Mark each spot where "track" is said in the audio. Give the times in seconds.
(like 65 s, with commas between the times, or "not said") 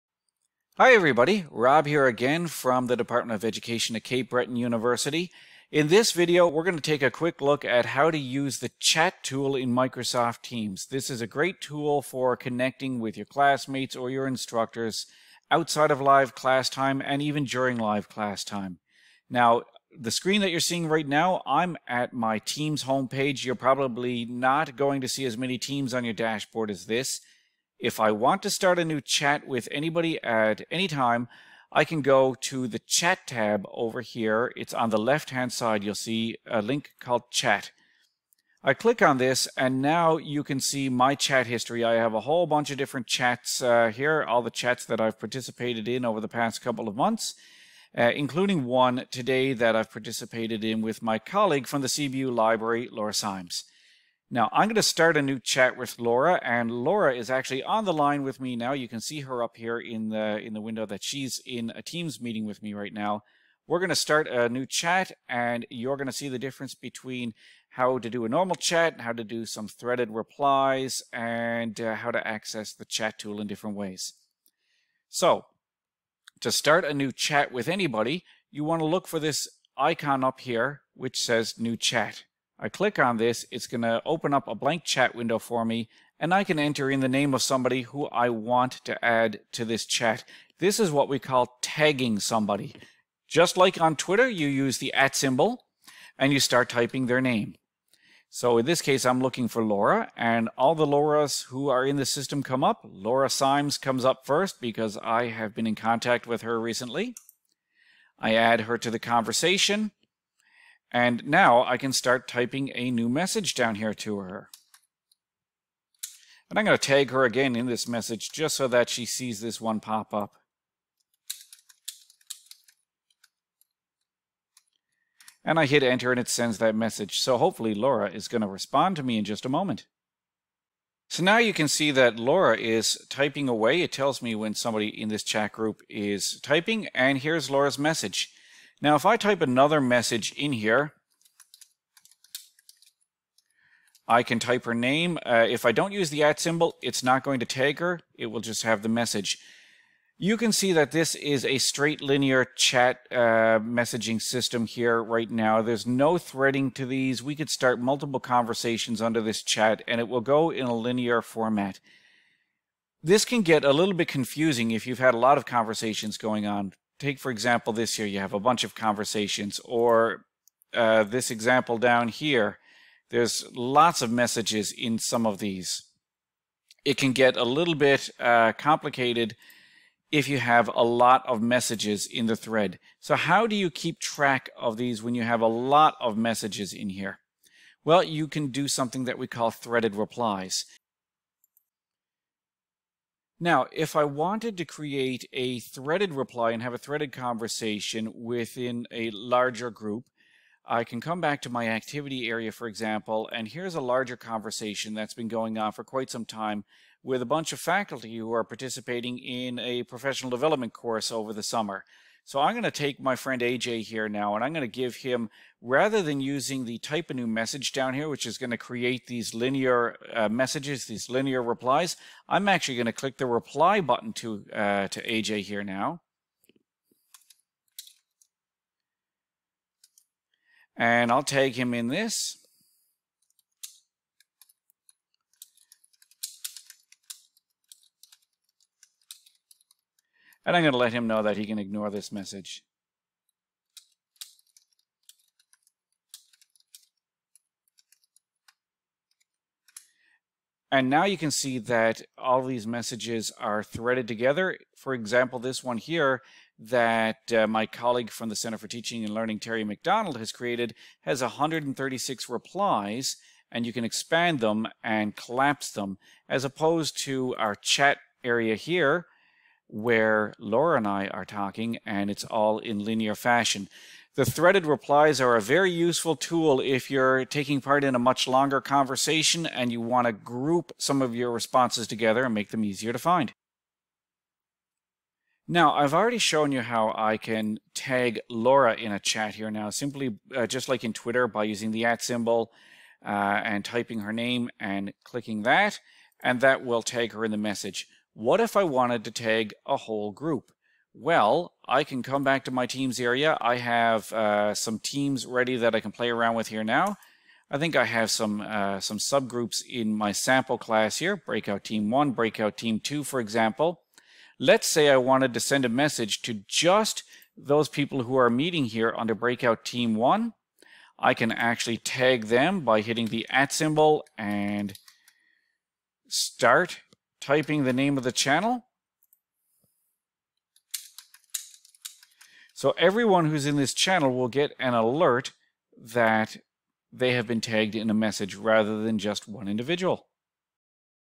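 183 s.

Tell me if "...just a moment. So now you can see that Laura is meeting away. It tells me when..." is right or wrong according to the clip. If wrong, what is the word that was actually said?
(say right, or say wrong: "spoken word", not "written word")
wrong: "typing", not "meeting".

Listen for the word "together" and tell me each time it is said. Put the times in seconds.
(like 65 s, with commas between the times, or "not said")
254 s, 281 s.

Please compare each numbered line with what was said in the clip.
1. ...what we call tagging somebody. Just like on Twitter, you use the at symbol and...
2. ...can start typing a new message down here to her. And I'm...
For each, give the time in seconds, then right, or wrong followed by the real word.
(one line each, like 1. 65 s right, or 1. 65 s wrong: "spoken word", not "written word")
1. 90 s right
2. 111 s right.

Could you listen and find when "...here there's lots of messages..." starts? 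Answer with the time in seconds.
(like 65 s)
172 s.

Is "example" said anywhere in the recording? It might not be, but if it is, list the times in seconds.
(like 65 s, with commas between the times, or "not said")
167 s, 171 s, 202 s, 254 s, 313 s.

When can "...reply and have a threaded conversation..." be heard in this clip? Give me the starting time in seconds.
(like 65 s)
196 s.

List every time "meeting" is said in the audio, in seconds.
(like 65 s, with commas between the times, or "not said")
62 s, 318 s.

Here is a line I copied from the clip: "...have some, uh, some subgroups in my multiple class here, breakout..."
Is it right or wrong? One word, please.
wrong.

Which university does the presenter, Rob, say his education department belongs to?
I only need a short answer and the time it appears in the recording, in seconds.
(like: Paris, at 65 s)
Cape Breton University, at 4 s.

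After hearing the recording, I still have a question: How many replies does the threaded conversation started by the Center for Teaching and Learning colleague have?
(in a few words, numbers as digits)
136.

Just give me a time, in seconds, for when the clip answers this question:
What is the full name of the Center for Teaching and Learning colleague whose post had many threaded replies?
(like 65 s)
259 s.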